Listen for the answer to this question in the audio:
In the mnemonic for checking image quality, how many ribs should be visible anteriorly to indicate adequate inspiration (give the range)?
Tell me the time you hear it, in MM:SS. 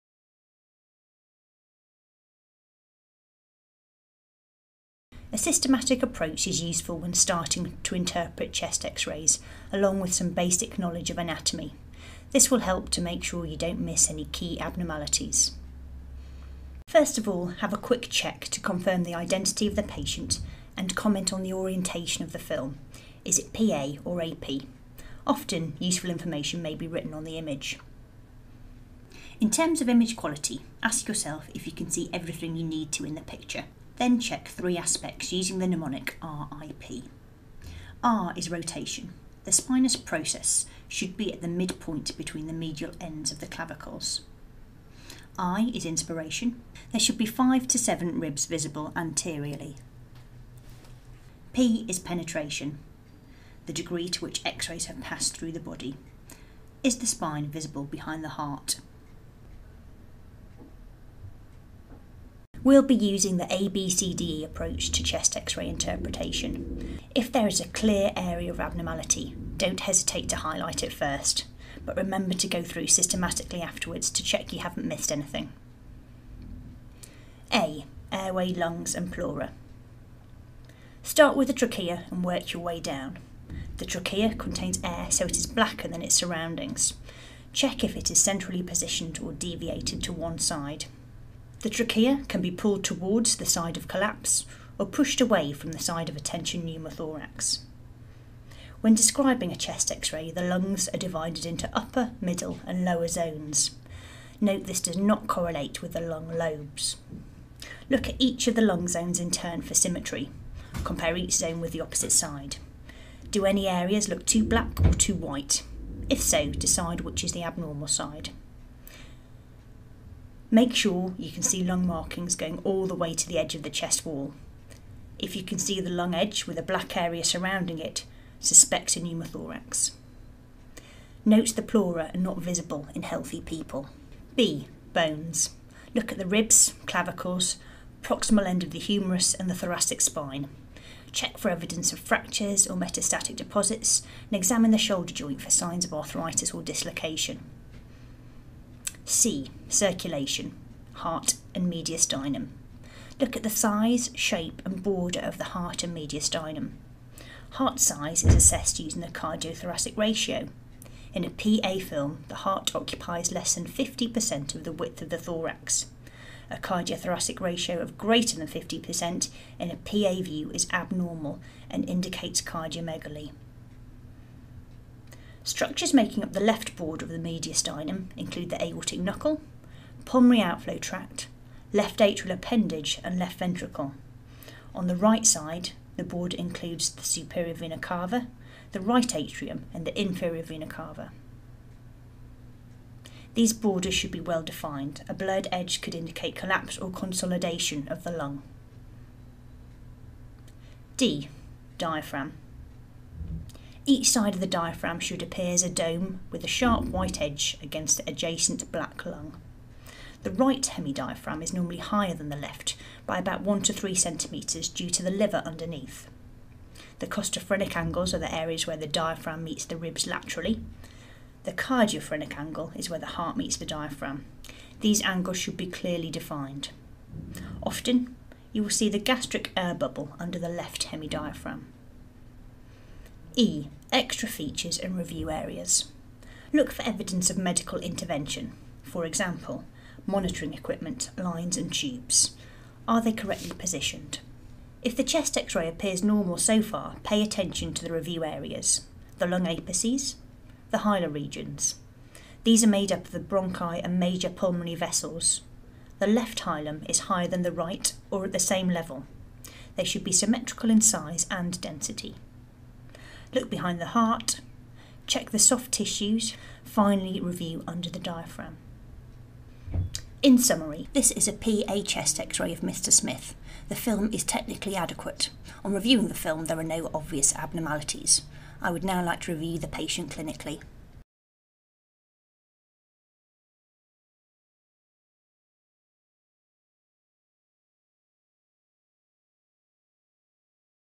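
00:47.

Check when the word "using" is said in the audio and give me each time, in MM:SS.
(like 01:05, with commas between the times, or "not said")
00:35, 01:02, 02:38.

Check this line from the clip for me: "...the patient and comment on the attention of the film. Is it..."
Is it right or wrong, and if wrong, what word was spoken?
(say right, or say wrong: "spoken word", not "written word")
wrong: "orientation", not "attention".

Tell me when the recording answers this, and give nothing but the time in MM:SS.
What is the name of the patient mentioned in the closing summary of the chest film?
04:32.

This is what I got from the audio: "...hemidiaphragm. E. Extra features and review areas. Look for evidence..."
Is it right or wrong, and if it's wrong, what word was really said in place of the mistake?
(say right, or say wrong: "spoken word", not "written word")
right.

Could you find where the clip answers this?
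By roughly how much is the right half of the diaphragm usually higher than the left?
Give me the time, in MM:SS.
03:33.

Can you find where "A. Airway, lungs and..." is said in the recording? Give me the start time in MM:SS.
01:17.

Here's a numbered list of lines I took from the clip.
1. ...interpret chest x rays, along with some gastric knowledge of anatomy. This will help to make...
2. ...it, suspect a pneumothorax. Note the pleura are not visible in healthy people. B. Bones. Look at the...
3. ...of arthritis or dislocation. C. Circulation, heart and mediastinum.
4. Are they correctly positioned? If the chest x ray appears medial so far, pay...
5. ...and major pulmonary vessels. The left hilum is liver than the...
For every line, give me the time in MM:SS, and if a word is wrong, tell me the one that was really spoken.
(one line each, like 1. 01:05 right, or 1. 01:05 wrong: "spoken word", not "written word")
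1. 00:07 wrong: "basic", not "gastric"
2. 02:07 right
3. 02:25 right
4. 04:02 wrong: "normal", not "medial"
5. 04:13 wrong: "higher", not "liver".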